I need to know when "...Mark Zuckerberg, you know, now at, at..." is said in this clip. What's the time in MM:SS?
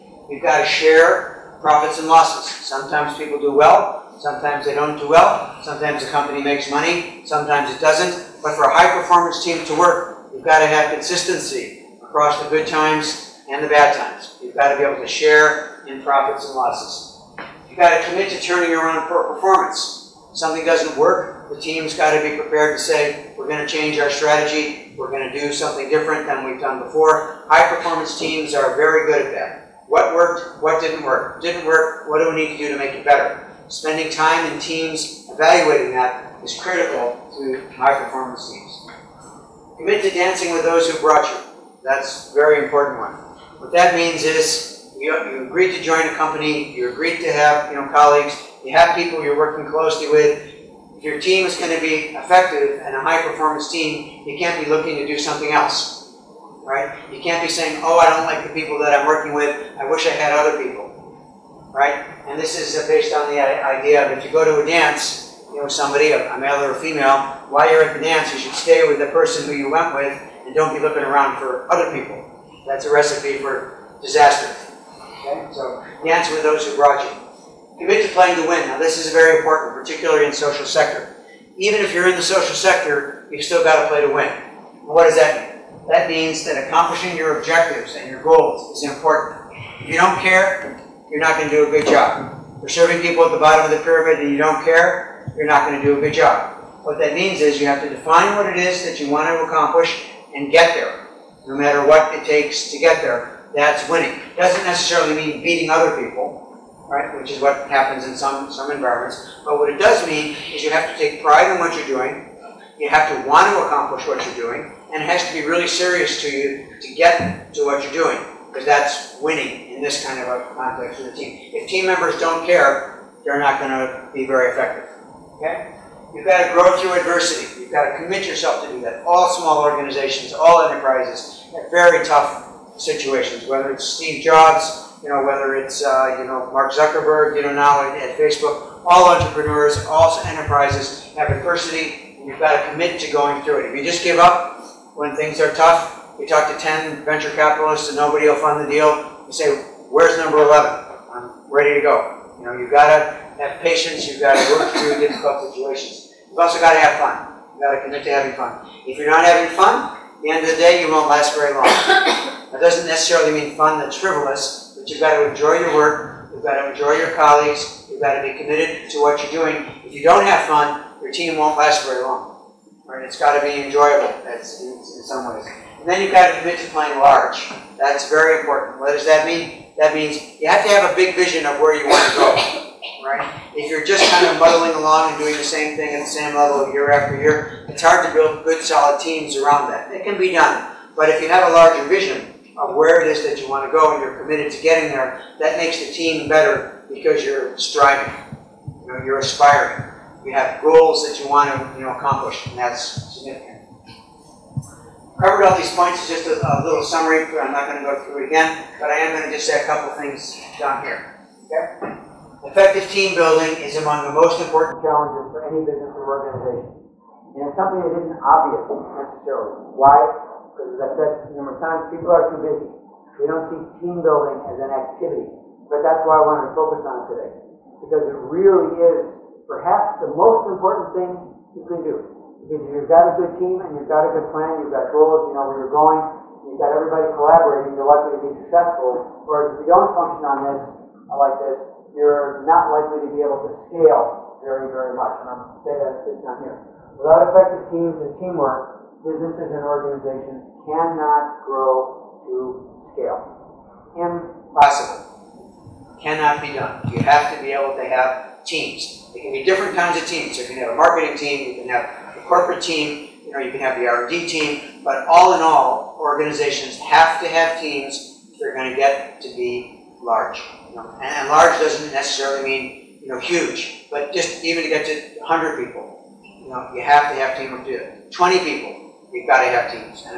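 02:16.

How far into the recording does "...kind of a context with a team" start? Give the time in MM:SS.
02:00.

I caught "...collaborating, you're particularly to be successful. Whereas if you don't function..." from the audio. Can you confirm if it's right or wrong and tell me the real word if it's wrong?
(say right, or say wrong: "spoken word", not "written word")
wrong: "likely", not "particularly".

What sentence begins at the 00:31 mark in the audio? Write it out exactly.
Didn't work, what do we need to do to make it better?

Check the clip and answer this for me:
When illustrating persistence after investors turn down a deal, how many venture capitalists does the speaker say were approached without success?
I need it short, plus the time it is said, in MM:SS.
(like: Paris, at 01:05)
10, at 02:26.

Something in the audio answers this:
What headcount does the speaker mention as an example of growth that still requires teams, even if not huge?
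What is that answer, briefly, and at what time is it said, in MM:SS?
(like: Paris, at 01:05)
100 people, at 04:35.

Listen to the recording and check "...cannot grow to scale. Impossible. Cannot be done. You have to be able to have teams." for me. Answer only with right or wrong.
right.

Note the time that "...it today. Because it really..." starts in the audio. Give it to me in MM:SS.
03:47.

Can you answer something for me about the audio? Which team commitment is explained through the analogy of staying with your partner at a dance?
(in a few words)
Dancing with those who brought you.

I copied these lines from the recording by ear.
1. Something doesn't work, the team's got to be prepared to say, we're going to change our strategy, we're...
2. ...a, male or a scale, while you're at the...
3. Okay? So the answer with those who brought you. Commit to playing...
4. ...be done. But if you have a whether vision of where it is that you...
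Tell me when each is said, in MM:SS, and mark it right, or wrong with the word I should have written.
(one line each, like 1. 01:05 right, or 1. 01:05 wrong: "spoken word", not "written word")
1. 00:20 right
2. 01:06 wrong: "female", not "scale"
3. 01:15 right
4. 03:10 wrong: "larger", not "whether".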